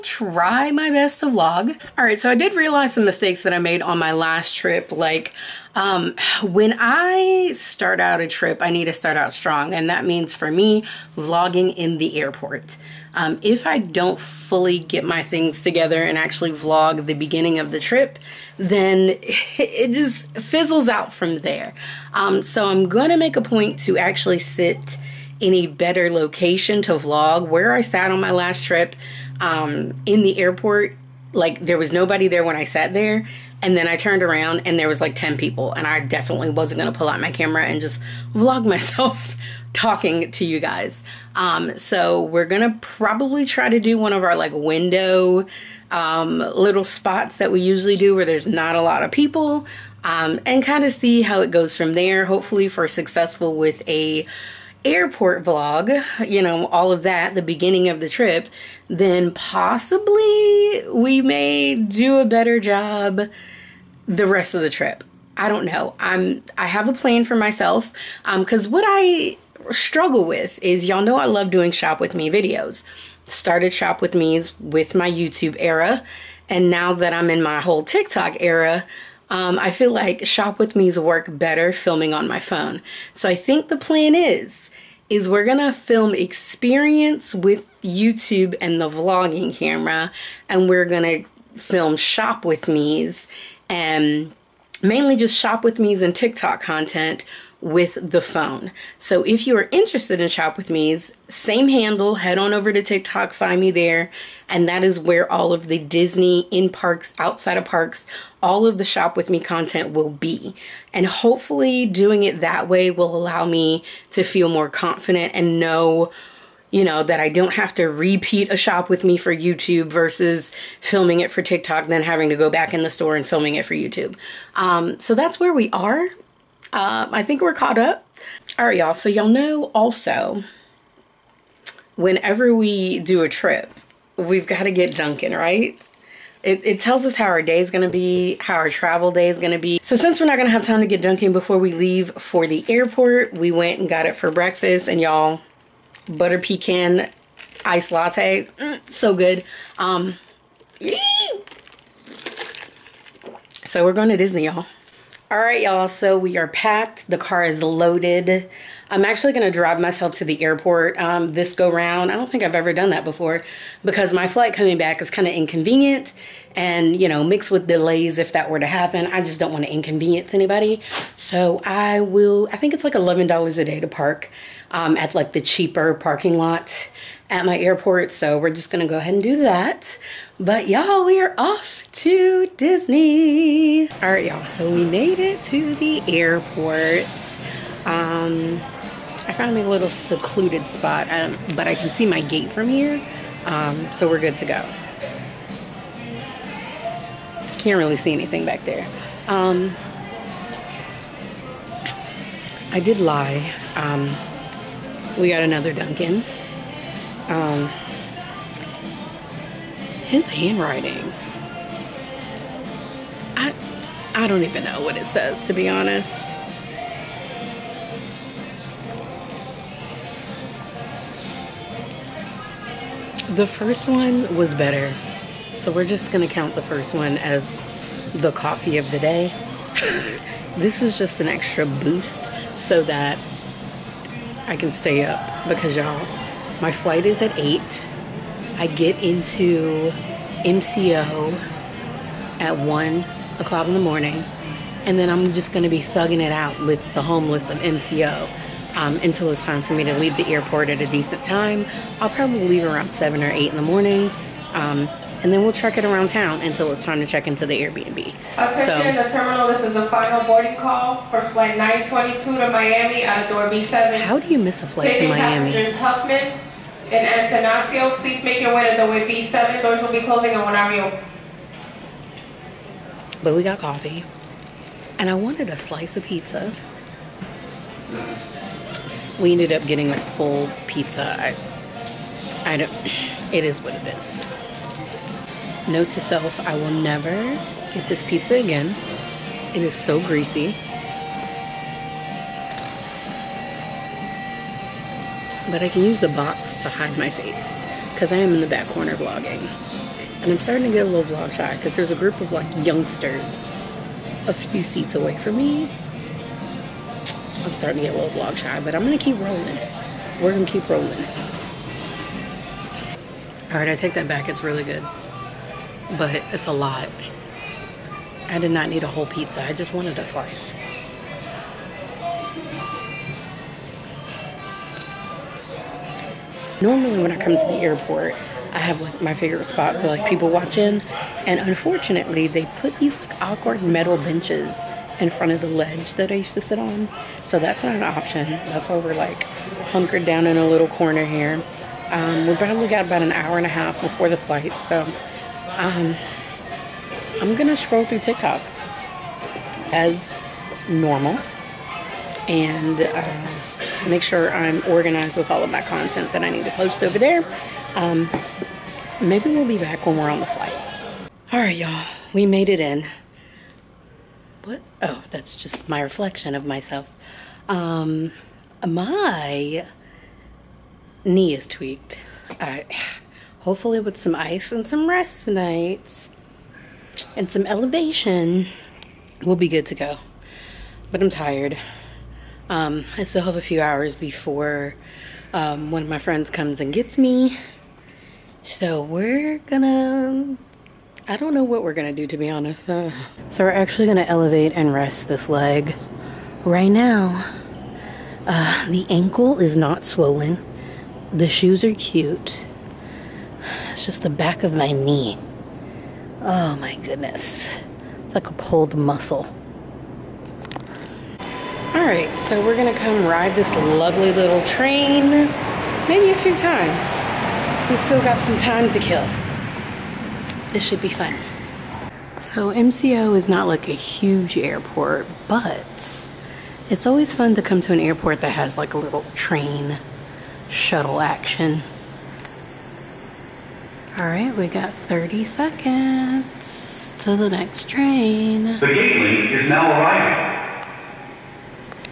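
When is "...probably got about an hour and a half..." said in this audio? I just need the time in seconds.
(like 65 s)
342 s.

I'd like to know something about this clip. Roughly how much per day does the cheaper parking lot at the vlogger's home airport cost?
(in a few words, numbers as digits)
$11.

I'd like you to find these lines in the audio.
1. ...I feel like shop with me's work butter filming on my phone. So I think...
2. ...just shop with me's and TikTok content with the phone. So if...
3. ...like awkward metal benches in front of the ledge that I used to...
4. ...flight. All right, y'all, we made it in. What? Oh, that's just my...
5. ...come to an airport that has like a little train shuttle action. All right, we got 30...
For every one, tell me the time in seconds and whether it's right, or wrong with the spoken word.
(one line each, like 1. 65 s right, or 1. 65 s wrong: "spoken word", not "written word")
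1. 79 s wrong: "better", not "butter"
2. 95 s right
3. 333 s right
4. 360 s right
5. 427 s right.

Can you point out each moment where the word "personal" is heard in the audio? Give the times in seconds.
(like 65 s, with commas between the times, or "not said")
not said.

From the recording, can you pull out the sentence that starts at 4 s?
Like um, when I start out a trip, I need to start out strong.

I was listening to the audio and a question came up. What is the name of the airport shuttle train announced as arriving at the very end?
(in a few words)
The Gateway.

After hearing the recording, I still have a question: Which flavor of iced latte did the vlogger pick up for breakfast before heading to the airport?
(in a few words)
Butter pecan.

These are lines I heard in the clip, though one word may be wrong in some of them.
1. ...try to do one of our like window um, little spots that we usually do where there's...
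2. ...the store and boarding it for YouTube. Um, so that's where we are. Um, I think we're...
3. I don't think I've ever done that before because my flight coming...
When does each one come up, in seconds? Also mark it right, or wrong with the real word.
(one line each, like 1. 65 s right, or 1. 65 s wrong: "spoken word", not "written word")
1. 43 s right
2. 122 s wrong: "filming", not "boarding"
3. 162 s right.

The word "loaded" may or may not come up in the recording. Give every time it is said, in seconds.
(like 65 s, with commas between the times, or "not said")
157 s.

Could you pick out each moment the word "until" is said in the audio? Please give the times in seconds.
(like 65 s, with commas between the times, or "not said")
249 s, 256 s.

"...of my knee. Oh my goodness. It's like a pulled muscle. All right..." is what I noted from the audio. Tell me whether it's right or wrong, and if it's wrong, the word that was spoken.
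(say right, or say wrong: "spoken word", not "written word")
right.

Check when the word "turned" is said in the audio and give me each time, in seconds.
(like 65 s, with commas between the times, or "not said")
33 s.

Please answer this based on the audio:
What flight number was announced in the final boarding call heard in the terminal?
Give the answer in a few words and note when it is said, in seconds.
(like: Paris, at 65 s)
922, at 261 s.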